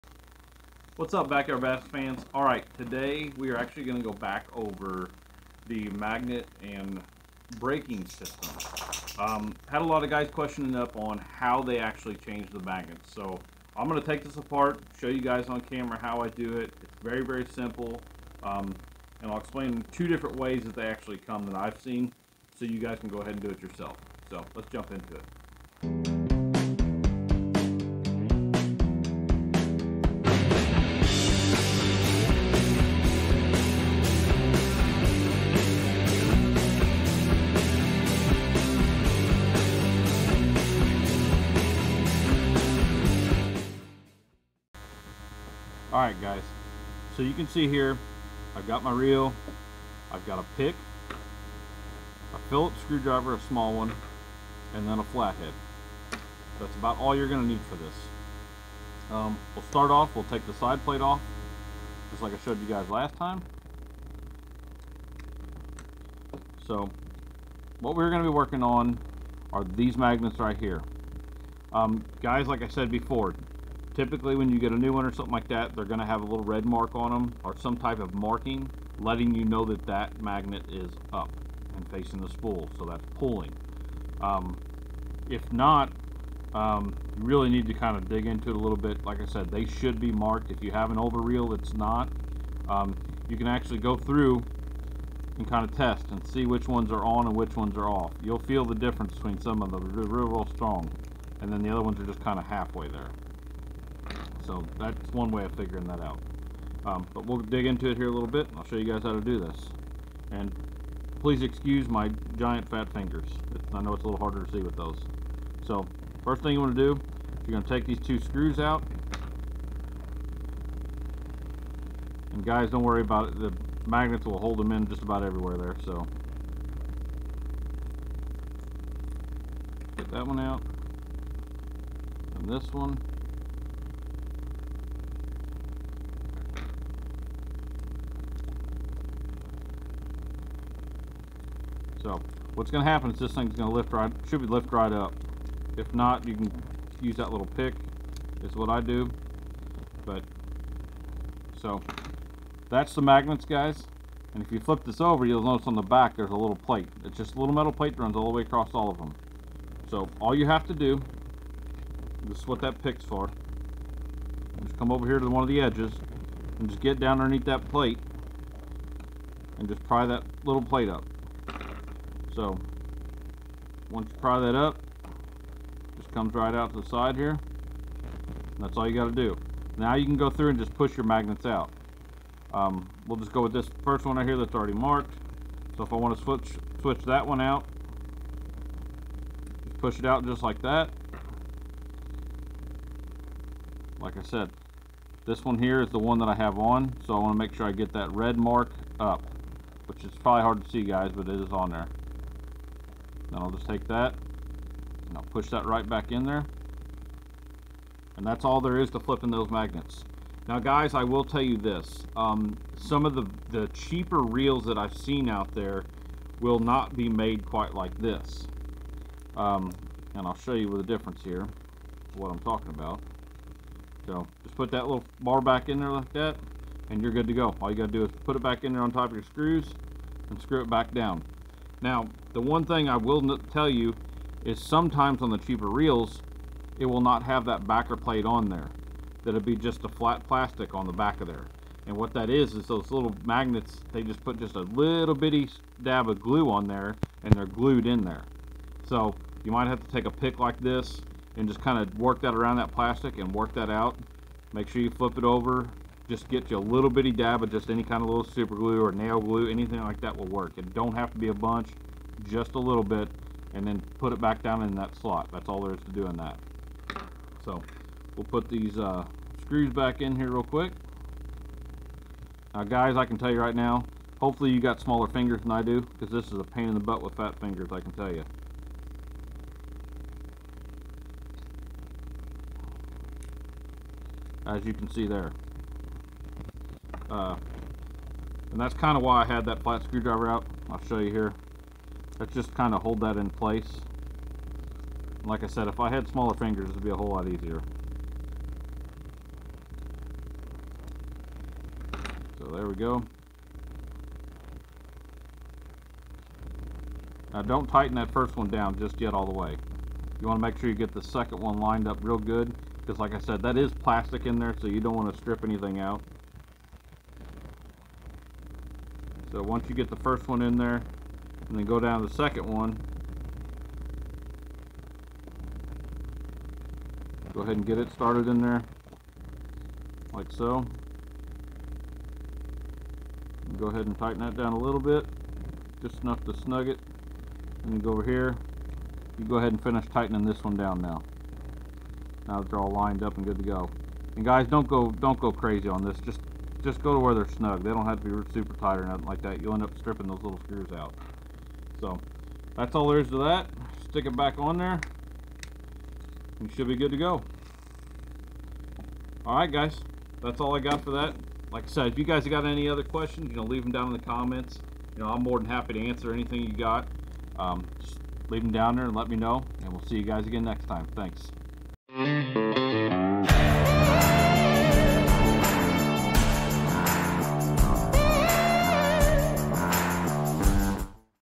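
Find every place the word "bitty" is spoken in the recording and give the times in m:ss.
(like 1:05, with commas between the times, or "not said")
4:05, 4:16.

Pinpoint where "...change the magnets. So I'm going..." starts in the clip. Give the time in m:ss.
0:12.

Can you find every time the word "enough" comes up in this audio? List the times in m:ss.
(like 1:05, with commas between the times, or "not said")
5:36.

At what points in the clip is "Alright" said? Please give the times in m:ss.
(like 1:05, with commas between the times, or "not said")
0:46, 5:59.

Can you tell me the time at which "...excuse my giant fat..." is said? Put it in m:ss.
1:51.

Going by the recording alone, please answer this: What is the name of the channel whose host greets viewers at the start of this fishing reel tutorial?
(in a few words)
Backyard Bass.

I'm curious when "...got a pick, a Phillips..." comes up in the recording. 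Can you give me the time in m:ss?
0:50.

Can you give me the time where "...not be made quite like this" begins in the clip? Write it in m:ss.
3:36.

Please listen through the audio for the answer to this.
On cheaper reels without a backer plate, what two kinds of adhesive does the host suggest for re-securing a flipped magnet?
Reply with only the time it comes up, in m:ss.
4:18.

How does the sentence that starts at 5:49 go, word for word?
You'll end up stripping those little screws out.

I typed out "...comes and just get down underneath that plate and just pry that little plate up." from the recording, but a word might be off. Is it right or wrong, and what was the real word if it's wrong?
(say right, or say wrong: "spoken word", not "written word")
wrong: "edges", not "comes".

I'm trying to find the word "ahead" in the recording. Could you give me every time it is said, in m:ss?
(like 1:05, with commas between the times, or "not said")
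0:23, 5:27, 5:33, 5:39.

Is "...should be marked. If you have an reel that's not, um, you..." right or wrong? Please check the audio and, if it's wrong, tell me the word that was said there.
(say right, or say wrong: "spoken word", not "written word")
right.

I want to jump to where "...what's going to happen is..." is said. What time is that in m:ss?
2:22.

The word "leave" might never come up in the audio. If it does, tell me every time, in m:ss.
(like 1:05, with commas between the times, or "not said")
6:03, 6:08.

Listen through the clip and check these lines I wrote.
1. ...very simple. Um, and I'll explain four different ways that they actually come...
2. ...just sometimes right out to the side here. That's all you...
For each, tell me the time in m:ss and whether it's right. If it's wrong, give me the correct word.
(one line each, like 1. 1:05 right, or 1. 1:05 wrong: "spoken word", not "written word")
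1. 0:17 wrong: "two", not "four"
2. 2:55 wrong: "comes", not "sometimes".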